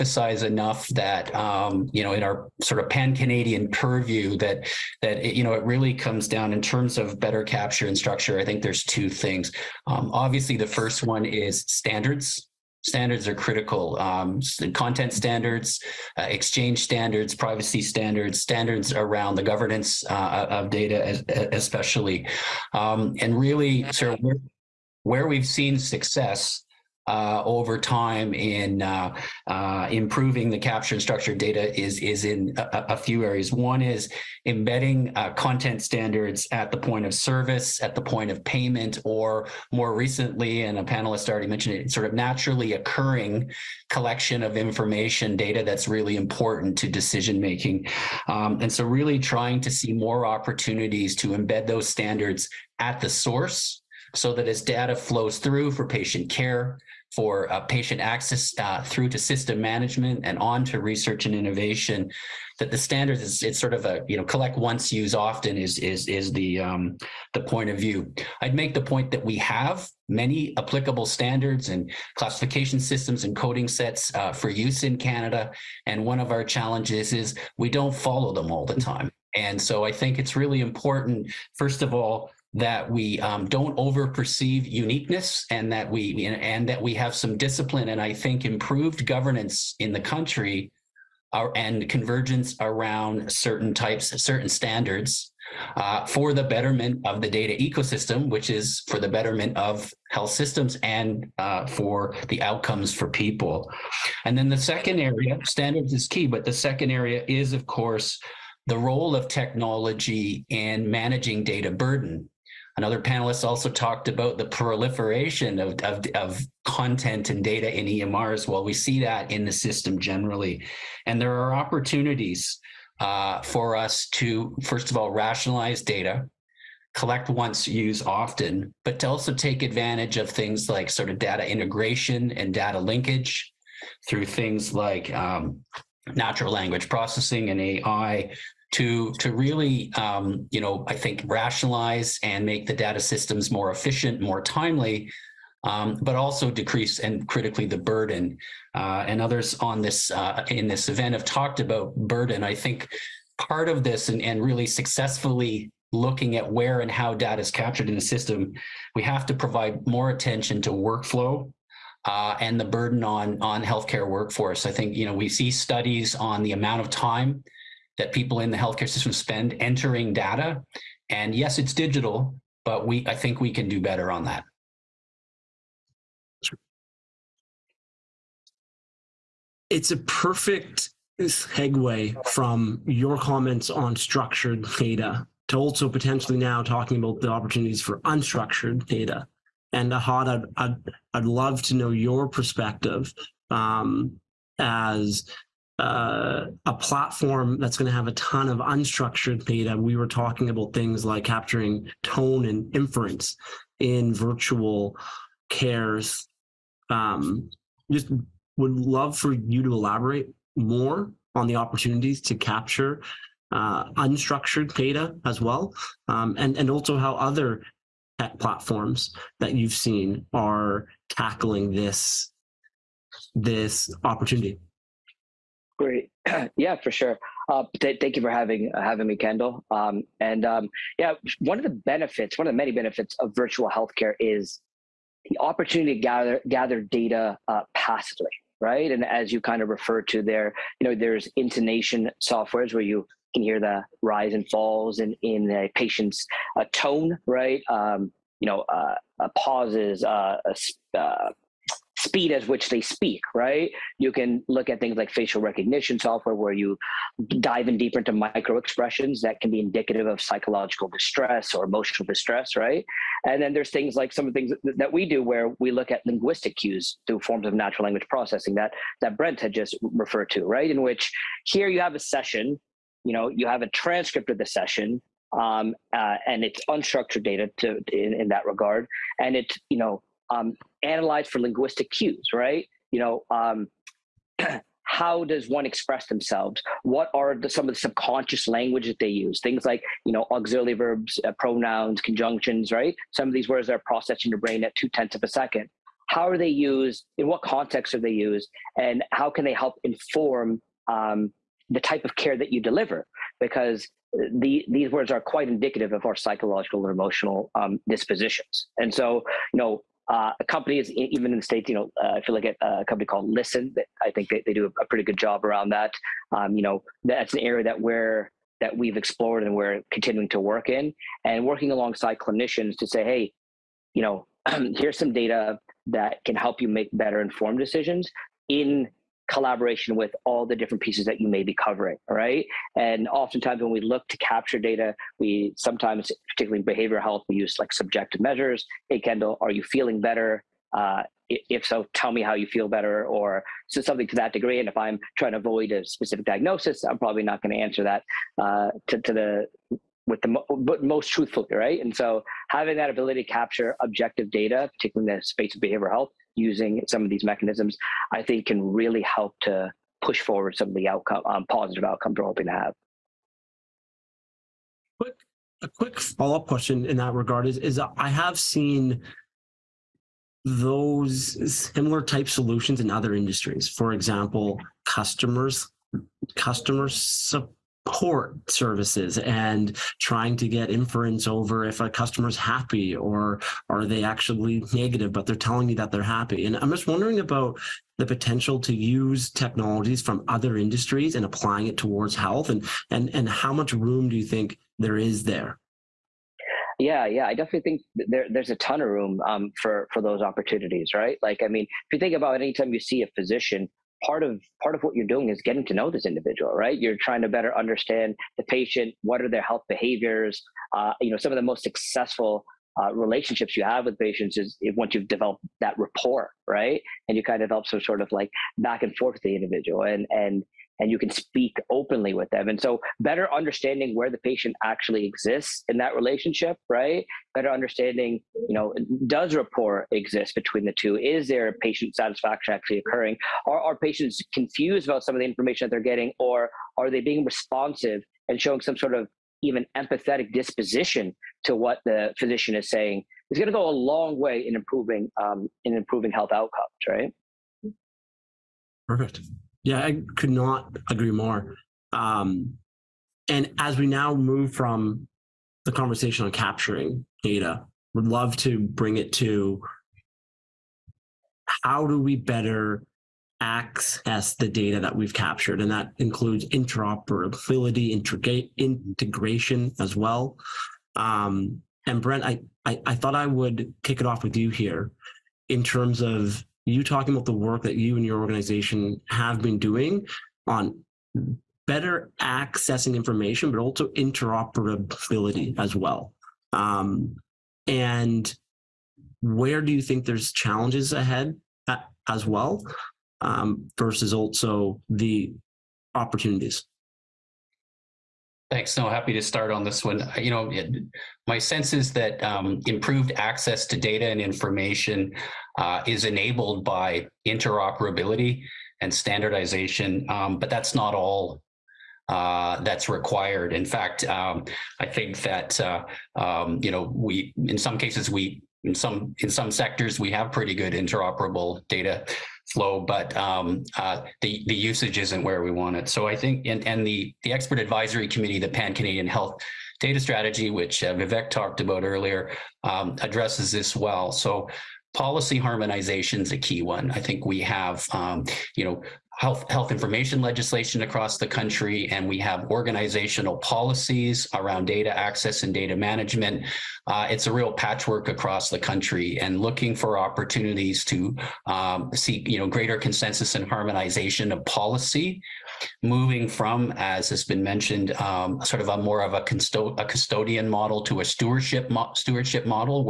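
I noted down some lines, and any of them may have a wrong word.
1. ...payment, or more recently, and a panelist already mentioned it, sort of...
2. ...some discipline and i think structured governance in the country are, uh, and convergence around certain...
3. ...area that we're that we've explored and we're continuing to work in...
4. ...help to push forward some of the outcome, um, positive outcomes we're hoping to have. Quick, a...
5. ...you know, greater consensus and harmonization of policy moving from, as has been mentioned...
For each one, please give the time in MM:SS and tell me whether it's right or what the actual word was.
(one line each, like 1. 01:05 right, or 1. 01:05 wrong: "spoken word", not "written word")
1. 00:38 right
2. 01:27 wrong: "improved", not "structured"
3. 05:17 right
4. 05:59 right
5. 09:12 right.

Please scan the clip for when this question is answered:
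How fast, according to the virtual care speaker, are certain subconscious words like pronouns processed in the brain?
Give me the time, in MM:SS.
04:54.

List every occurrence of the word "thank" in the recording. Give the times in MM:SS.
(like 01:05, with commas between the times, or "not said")
03:47, 08:18.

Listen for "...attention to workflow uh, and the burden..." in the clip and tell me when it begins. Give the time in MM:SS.
02:40.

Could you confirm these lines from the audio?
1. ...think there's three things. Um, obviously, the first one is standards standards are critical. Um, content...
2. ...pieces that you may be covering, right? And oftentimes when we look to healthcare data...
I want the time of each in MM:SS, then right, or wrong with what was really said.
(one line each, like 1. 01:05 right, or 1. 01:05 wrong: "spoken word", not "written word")
1. 00:08 wrong: "two", not "three"
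2. 05:30 wrong: "capture", not "healthcare".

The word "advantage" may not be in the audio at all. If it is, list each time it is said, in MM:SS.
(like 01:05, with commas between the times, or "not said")
02:09.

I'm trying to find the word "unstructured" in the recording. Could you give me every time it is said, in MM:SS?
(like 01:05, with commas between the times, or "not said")
03:08, 03:18, 03:33, 04:36.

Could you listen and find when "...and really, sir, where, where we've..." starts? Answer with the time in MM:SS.
00:23.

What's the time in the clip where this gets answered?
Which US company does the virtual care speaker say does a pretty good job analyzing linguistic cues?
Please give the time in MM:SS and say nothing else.
05:13.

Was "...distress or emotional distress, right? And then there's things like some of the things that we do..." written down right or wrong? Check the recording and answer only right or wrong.
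right.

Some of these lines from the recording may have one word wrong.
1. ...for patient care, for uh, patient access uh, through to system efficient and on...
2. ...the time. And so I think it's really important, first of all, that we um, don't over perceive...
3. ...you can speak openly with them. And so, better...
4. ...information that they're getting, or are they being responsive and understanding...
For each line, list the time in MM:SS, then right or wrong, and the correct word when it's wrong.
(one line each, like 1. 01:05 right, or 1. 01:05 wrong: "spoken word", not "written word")
1. 00:55 wrong: "management", not "efficient"
2. 01:18 right
3. 07:00 right
4. 07:15 wrong: "showing", not "understanding".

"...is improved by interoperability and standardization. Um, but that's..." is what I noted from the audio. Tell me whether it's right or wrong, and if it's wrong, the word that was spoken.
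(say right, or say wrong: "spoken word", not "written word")
wrong: "enabled", not "improved".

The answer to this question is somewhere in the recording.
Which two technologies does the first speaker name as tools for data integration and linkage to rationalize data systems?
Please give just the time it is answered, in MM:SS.
02:16.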